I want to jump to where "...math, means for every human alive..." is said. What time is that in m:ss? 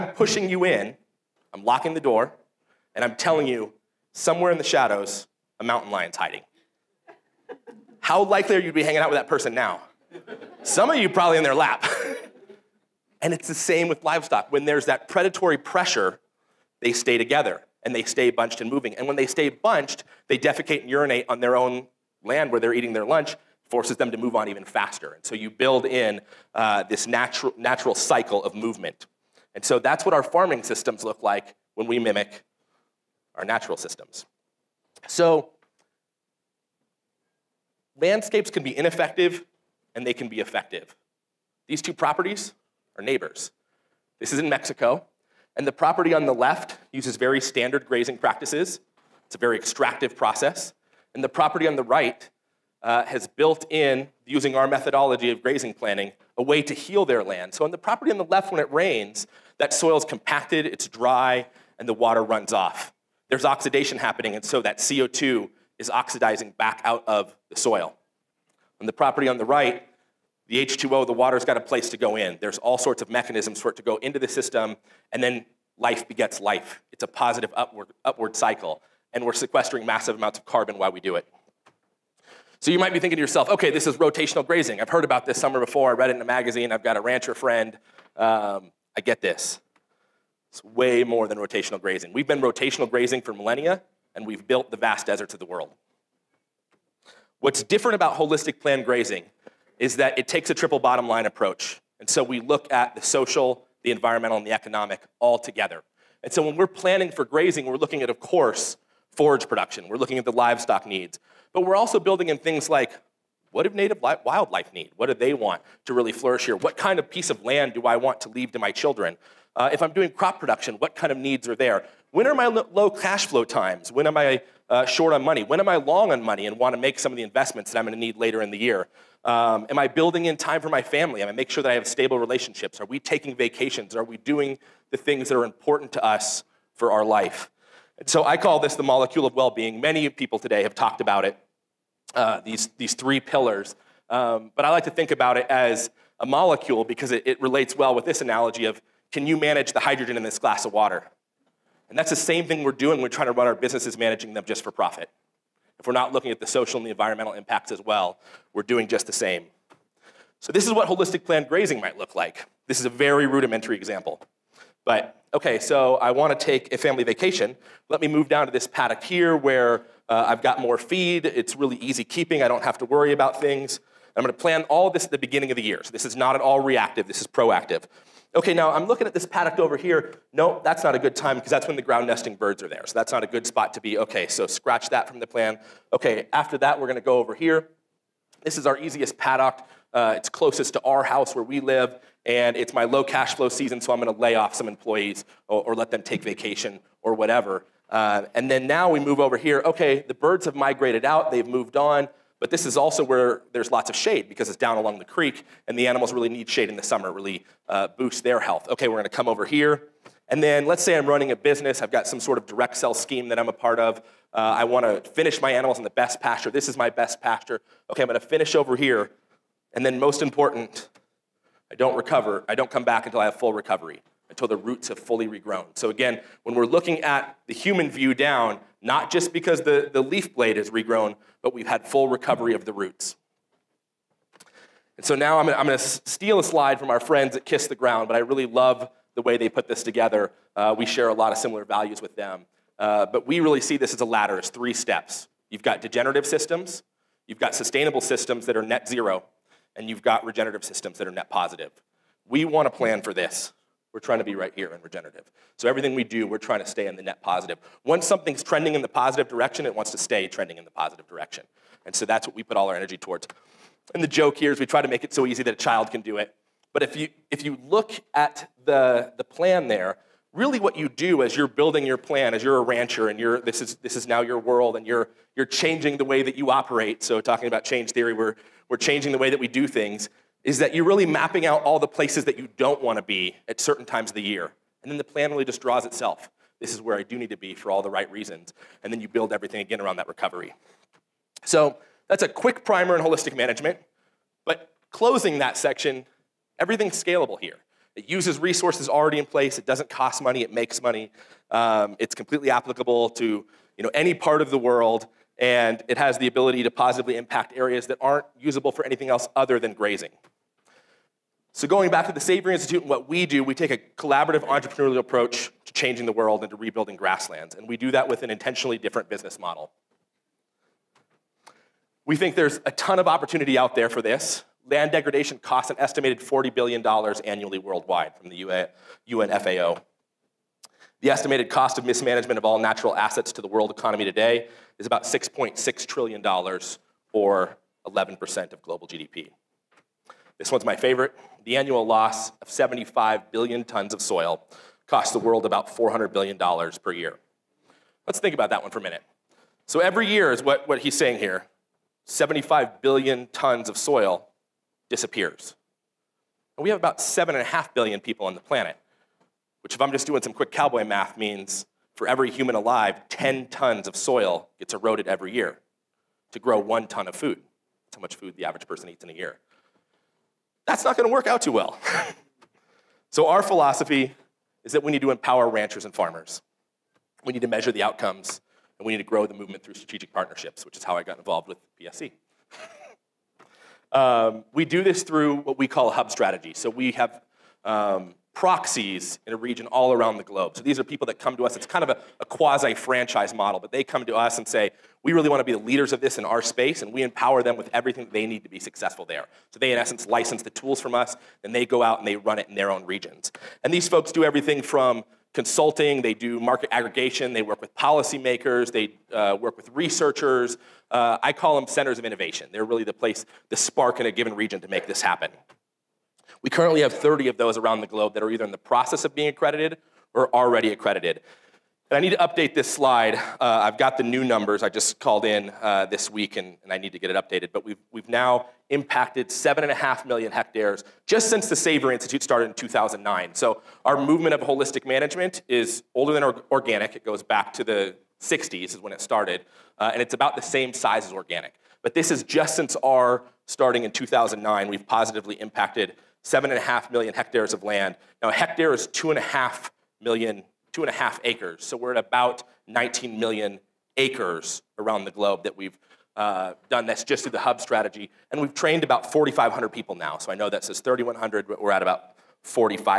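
6:00.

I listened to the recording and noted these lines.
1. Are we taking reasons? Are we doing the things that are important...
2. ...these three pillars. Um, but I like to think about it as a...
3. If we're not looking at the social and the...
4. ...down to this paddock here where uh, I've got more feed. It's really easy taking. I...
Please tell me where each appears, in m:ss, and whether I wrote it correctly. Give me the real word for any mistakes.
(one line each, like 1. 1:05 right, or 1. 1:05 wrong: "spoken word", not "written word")
1. 2:12 wrong: "vacations", not "reasons"
2. 2:22 right
3. 2:35 right
4. 2:48 wrong: "keeping", not "taking".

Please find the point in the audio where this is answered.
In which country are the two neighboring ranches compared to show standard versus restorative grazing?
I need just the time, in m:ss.
0:44.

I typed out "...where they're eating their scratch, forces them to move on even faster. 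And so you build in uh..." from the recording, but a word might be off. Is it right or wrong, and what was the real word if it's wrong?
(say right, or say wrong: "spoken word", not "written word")
wrong: "lunch", not "scratch".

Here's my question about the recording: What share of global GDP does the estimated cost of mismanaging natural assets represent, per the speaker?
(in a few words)
11%.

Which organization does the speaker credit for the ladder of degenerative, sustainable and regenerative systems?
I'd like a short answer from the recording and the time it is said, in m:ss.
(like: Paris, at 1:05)
Kiss the Ground, at 3:57.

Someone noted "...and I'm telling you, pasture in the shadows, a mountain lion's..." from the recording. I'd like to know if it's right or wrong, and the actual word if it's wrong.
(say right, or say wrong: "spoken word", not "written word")
wrong: "somewhere", not "pasture".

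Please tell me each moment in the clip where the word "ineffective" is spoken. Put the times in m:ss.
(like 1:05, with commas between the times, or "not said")
0:38.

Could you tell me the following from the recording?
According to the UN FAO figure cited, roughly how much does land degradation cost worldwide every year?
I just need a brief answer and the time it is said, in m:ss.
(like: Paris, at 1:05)
$40 billion, at 5:26.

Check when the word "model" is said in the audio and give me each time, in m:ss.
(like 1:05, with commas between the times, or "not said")
5:19, 6:33.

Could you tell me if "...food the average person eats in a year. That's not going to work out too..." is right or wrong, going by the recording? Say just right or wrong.
right.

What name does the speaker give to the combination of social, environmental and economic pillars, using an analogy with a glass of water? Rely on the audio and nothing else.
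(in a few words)
molecule of well being.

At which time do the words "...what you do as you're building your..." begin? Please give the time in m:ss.
4:30.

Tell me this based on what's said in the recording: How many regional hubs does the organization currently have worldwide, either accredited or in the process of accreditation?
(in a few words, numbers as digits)
30.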